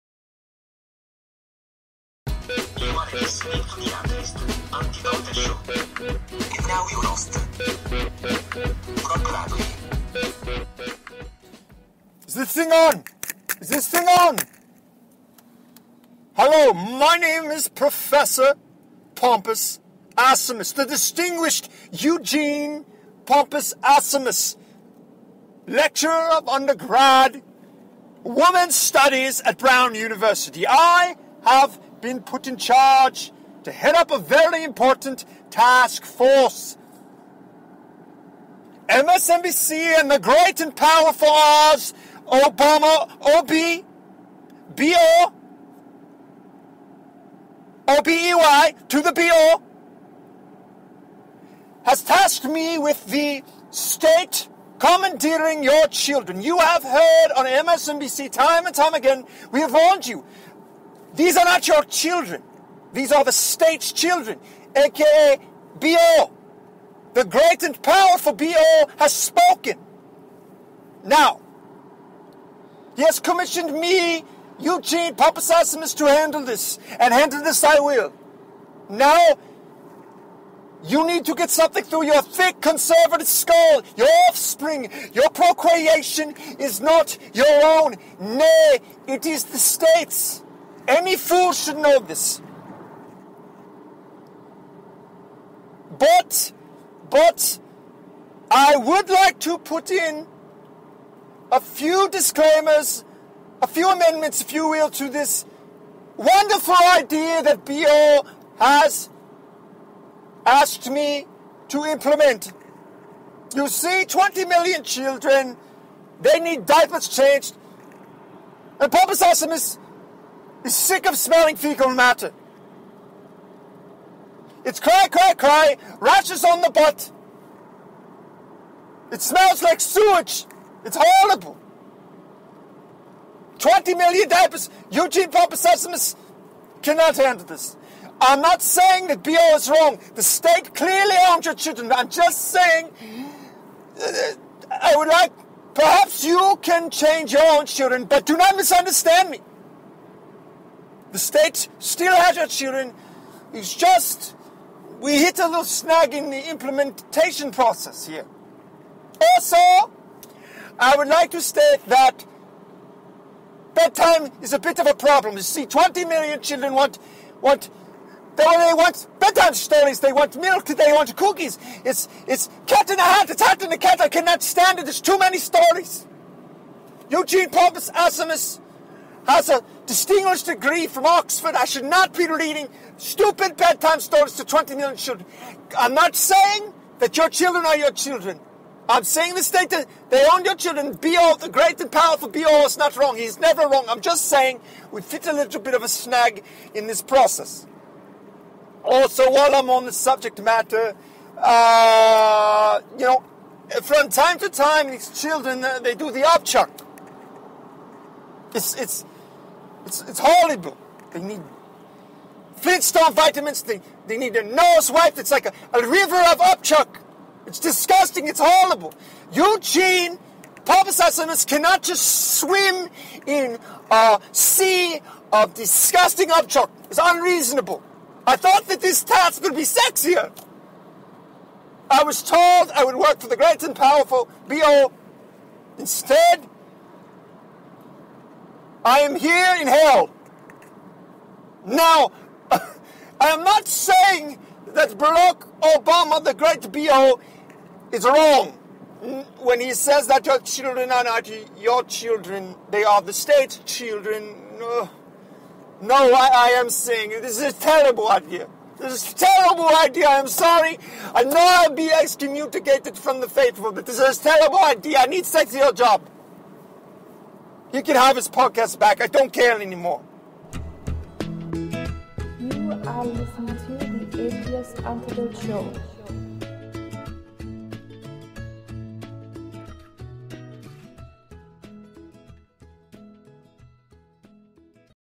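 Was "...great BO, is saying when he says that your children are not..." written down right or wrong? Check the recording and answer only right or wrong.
wrong.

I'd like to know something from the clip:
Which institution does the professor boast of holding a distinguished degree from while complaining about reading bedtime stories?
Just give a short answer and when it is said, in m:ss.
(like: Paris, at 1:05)
Oxford, at 3:01.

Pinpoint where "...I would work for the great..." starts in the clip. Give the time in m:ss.
3:52.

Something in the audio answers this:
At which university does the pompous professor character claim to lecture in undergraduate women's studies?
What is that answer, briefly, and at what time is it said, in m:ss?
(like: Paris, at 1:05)
Brown University, at 0:29.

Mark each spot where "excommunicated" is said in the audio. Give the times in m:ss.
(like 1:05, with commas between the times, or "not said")
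4:21.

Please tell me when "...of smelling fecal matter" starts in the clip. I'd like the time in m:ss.
2:01.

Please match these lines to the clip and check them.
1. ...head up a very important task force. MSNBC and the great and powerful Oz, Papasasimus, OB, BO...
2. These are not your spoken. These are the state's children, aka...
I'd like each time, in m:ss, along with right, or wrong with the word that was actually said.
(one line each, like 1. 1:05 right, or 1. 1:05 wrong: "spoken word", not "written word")
1. 0:33 wrong: "Obama", not "Papasasimus"
2. 1:01 wrong: "children", not "spoken".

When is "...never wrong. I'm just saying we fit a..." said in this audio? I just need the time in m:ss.
3:13.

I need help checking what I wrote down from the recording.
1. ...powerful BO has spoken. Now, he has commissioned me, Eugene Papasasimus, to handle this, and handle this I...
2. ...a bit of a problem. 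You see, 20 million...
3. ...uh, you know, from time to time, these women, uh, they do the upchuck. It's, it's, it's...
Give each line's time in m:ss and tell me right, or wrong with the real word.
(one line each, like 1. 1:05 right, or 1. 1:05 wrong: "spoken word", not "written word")
1. 1:07 right
2. 2:44 right
3. 3:21 wrong: "children", not "women".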